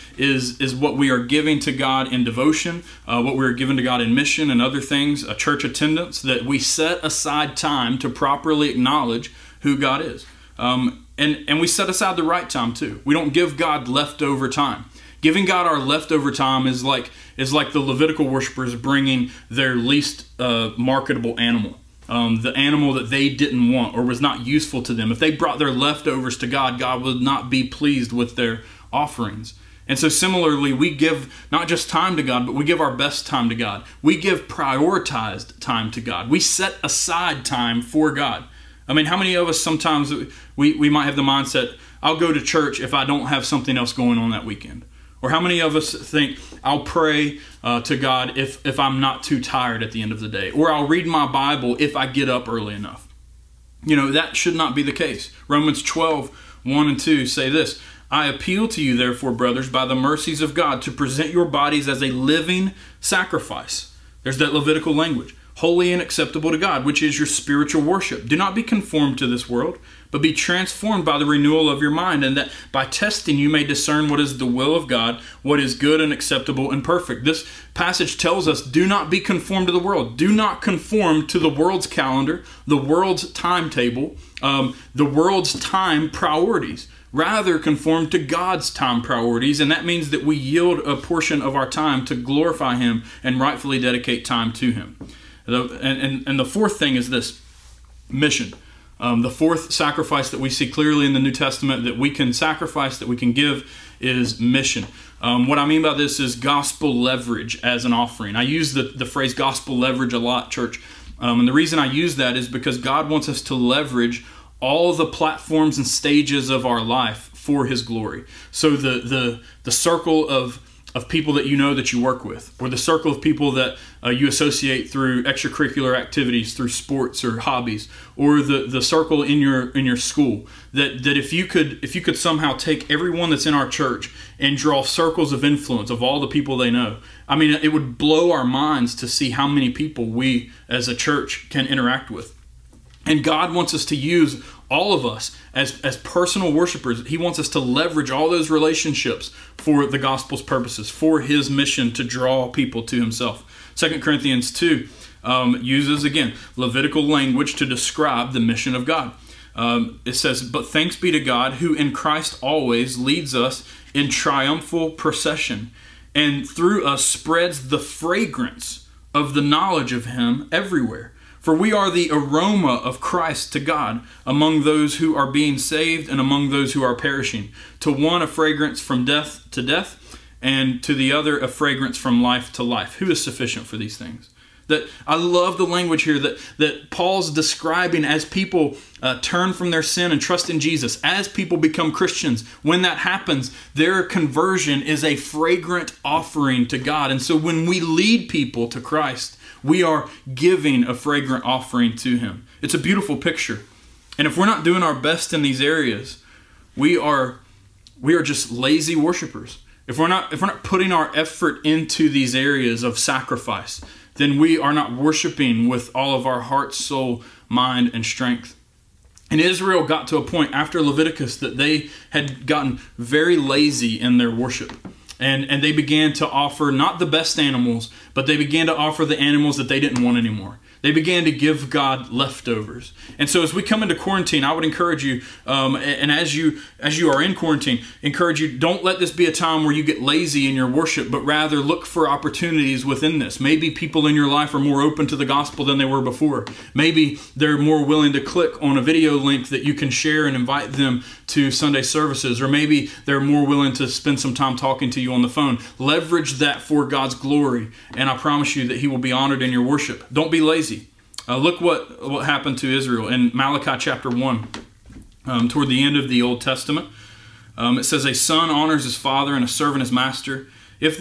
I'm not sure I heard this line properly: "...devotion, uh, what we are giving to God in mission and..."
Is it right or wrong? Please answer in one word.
right.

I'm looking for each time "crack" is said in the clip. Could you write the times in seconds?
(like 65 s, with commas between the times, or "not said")
not said.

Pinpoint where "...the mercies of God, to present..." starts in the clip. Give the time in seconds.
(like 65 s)
59 s.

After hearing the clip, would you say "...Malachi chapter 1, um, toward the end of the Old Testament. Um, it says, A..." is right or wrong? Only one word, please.
right.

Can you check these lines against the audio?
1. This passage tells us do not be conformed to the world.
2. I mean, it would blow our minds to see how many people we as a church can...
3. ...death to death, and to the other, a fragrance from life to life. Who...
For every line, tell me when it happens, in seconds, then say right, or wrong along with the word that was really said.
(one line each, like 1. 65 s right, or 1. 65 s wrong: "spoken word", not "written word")
1. 77 s right
2. 137 s right
3. 179 s right.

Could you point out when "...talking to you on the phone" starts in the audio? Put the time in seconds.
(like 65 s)
254 s.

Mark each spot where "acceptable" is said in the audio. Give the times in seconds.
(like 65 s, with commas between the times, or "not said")
66 s, 76 s.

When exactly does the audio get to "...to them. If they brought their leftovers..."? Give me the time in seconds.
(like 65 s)
24 s.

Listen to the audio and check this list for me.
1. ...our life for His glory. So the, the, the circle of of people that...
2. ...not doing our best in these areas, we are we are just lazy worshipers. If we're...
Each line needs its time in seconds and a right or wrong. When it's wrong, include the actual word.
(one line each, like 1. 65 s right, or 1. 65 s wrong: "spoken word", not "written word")
1. 116 s right
2. 204 s right.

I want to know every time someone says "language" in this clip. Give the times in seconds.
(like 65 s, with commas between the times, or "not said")
64 s, 157 s, 185 s.